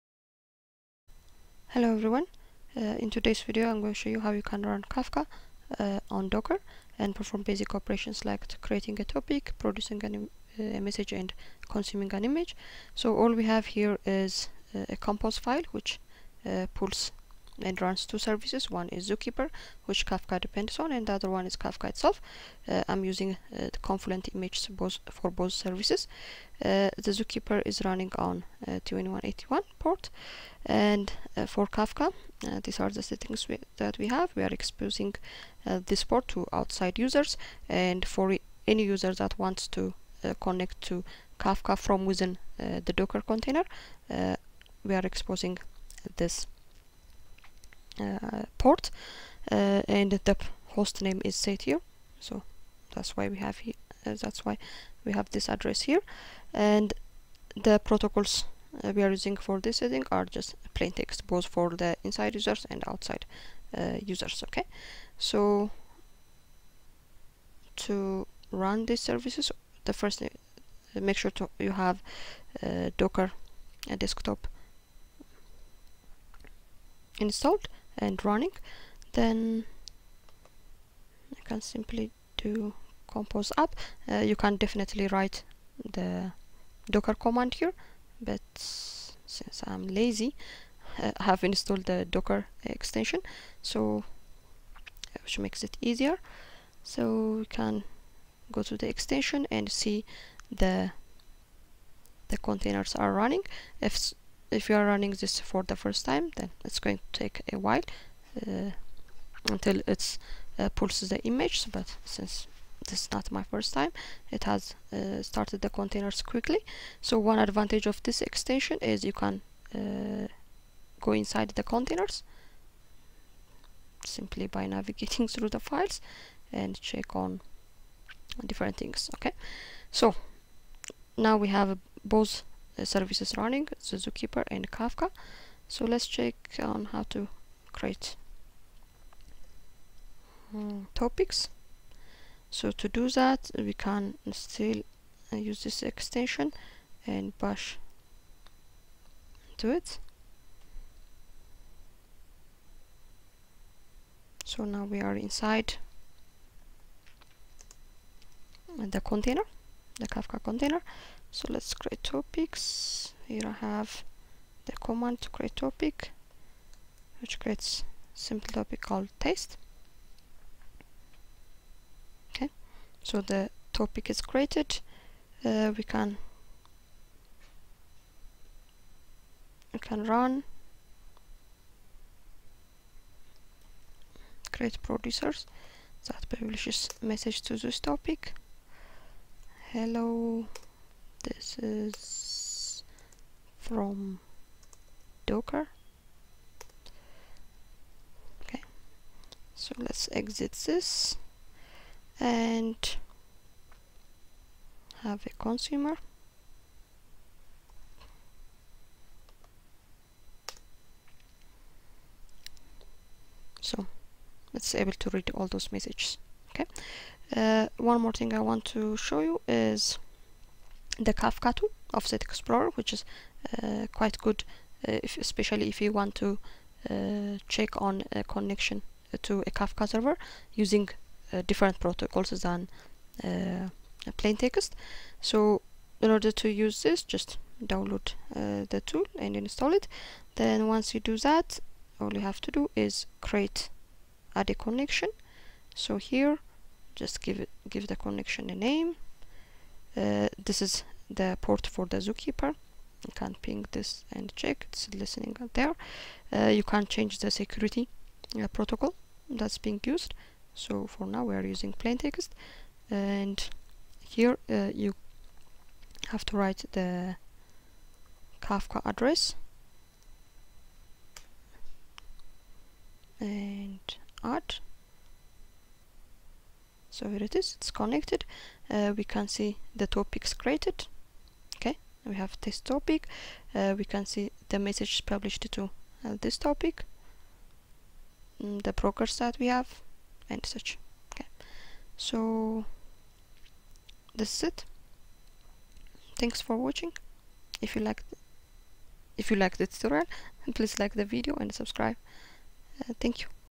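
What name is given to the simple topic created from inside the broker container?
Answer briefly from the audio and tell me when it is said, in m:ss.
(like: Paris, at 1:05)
taste, at 2:49.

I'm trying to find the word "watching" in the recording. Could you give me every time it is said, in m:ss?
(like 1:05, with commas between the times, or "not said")
4:56.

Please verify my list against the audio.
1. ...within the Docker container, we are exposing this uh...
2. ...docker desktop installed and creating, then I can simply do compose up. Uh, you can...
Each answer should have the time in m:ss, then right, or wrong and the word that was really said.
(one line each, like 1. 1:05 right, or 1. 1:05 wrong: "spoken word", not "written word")
1. 0:42 right
2. 1:12 wrong: "running", not "creating".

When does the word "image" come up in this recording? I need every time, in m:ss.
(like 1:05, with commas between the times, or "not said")
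0:12, 0:24, 1:51.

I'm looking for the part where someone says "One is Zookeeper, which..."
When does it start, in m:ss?
0:18.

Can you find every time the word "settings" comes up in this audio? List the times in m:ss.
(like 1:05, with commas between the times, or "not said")
0:33, 0:59.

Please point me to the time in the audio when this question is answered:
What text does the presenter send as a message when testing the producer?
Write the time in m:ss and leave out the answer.
3:09.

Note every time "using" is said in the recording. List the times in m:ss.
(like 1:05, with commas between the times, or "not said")
0:23, 0:59, 3:50, 4:21.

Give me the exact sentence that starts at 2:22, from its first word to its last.
So to do that, we can still uh, use this extension and bash into it.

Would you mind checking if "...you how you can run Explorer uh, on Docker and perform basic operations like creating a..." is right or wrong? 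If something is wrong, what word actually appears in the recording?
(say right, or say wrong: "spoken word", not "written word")
wrong: "Kafka", not "Explorer".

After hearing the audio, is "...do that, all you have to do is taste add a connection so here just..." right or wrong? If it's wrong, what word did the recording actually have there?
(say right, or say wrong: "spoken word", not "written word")
wrong: "create", not "taste".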